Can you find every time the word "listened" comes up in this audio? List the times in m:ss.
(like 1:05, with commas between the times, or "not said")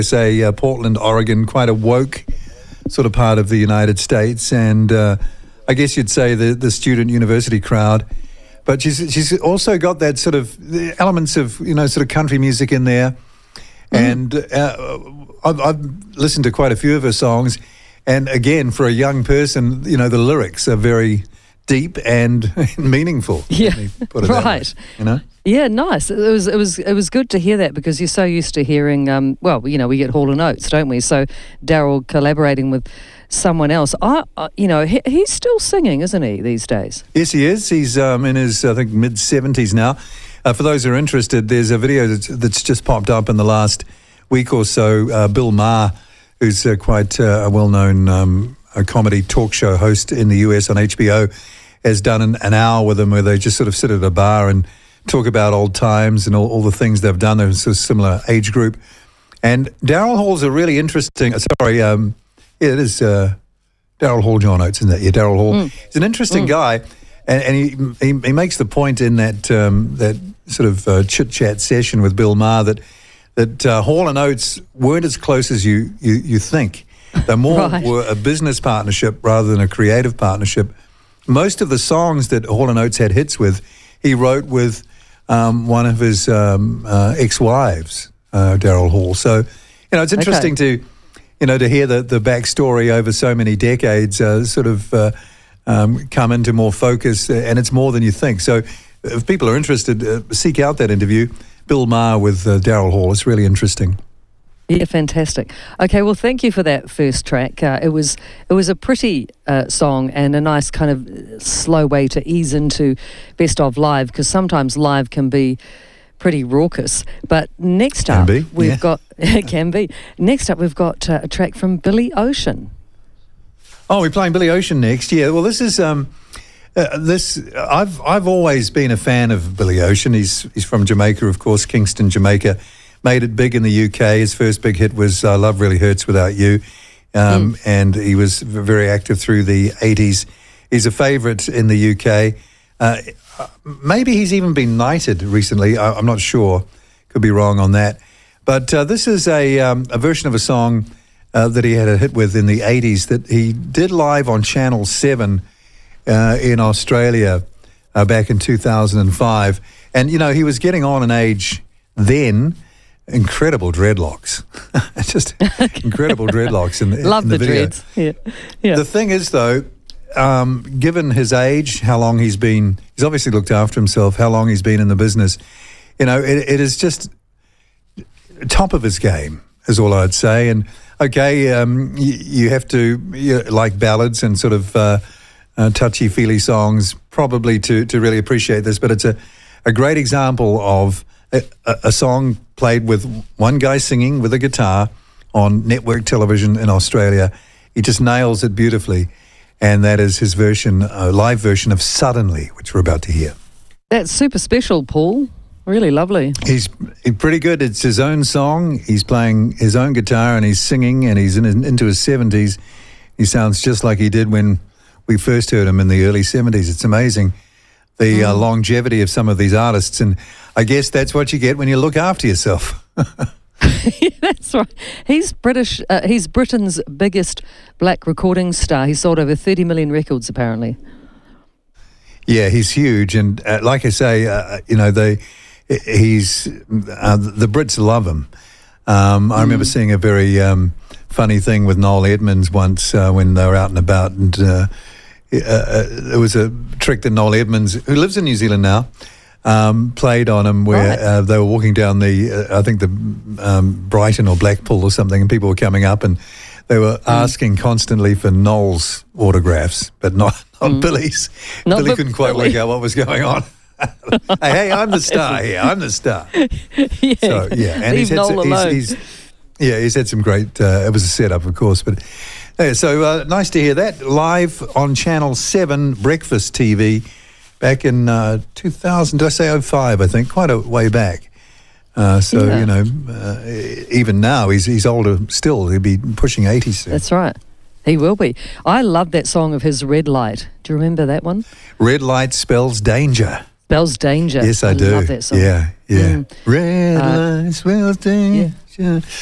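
0:16.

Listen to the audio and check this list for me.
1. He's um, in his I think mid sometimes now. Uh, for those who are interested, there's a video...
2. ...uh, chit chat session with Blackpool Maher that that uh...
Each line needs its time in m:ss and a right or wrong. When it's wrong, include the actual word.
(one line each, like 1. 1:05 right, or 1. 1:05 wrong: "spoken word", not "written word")
1. 0:37 wrong: "seventies", not "sometimes"
2. 1:10 wrong: "Bill", not "Blackpool".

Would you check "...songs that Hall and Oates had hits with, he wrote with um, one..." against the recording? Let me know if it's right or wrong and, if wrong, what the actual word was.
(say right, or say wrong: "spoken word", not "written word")
right.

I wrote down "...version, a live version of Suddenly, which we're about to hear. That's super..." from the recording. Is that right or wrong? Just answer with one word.
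right.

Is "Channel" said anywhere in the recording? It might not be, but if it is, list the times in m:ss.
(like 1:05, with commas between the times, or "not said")
2:34, 4:34.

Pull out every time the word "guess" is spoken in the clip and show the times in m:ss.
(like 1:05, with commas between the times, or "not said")
0:05, 3:40.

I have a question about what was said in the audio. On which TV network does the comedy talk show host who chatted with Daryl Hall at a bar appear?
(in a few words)
HBO.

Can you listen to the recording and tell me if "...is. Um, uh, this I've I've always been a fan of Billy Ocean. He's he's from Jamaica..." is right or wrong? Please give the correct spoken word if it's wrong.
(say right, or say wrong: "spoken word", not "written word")
right.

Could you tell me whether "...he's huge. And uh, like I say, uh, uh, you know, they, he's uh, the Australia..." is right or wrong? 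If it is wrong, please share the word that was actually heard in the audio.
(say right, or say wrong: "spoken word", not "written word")
wrong: "Brits", not "Australia".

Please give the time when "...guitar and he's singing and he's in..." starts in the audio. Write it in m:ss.
3:29.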